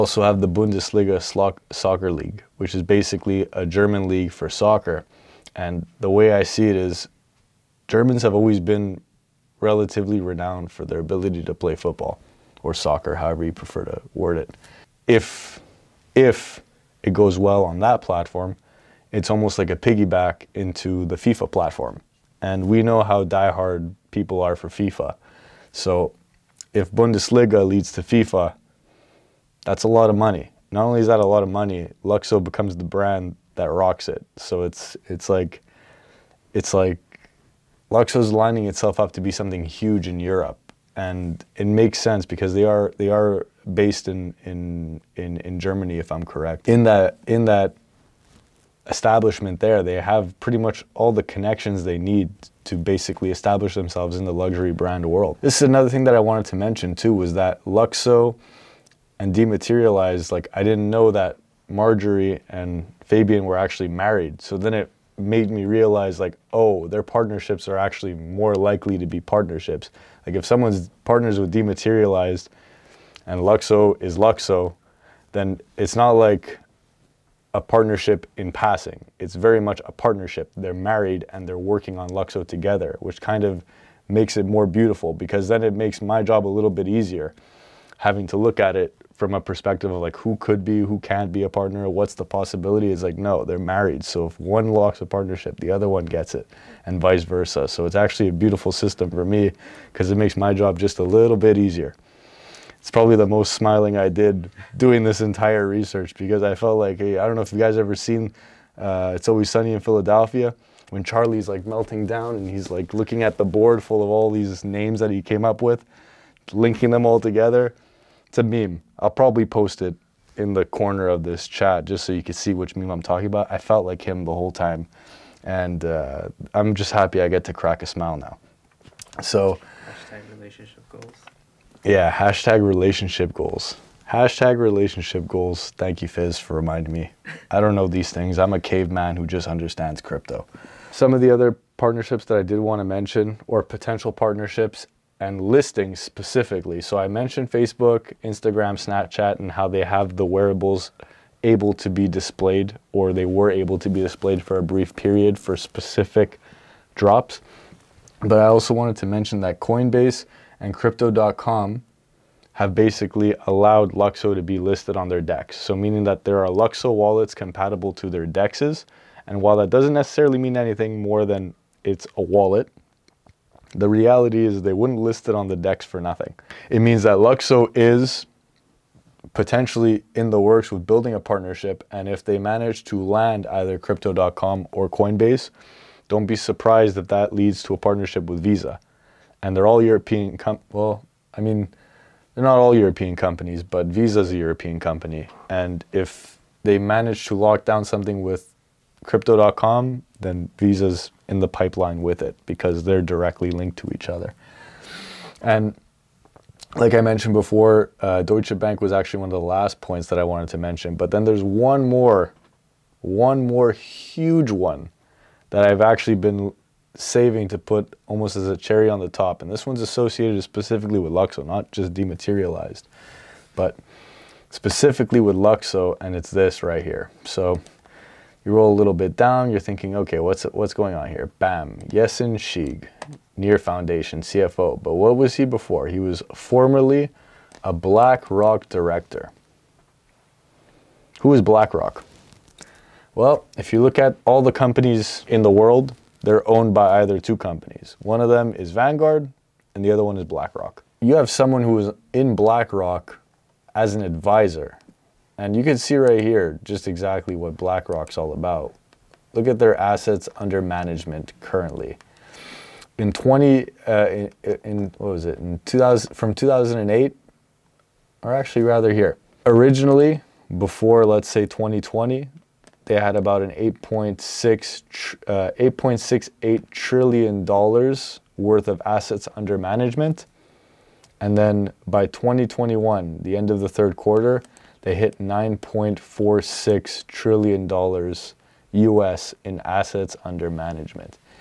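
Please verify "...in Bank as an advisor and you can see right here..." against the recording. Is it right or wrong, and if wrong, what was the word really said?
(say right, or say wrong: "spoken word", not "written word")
wrong: "BlackRock", not "Bank".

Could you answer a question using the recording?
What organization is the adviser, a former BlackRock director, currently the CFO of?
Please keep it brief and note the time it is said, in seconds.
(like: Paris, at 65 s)
Near Foundation, at 233 s.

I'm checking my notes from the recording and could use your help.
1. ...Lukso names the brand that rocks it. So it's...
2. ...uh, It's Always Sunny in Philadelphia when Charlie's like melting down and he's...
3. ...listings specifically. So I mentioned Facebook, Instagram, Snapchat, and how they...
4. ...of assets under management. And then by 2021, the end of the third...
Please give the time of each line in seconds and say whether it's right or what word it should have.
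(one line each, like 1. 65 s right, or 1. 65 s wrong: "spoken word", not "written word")
1. 32 s wrong: "becomes", not "names"
2. 108 s right
3. 145 s right
4. 278 s right.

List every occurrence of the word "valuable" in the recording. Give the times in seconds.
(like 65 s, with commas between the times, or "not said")
not said.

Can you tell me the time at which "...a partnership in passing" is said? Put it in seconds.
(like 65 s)
77 s.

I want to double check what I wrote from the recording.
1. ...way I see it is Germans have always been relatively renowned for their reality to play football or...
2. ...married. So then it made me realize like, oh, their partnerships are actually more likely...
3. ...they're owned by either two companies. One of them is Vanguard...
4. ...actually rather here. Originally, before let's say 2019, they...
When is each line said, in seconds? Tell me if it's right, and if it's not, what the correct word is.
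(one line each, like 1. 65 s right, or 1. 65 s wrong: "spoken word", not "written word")
1. 6 s wrong: "ability", not "reality"
2. 63 s right
3. 246 s right
4. 268 s wrong: "2020", not "2019".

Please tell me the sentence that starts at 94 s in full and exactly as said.
So if one locks a partnership, the other one gets it, and vice versa.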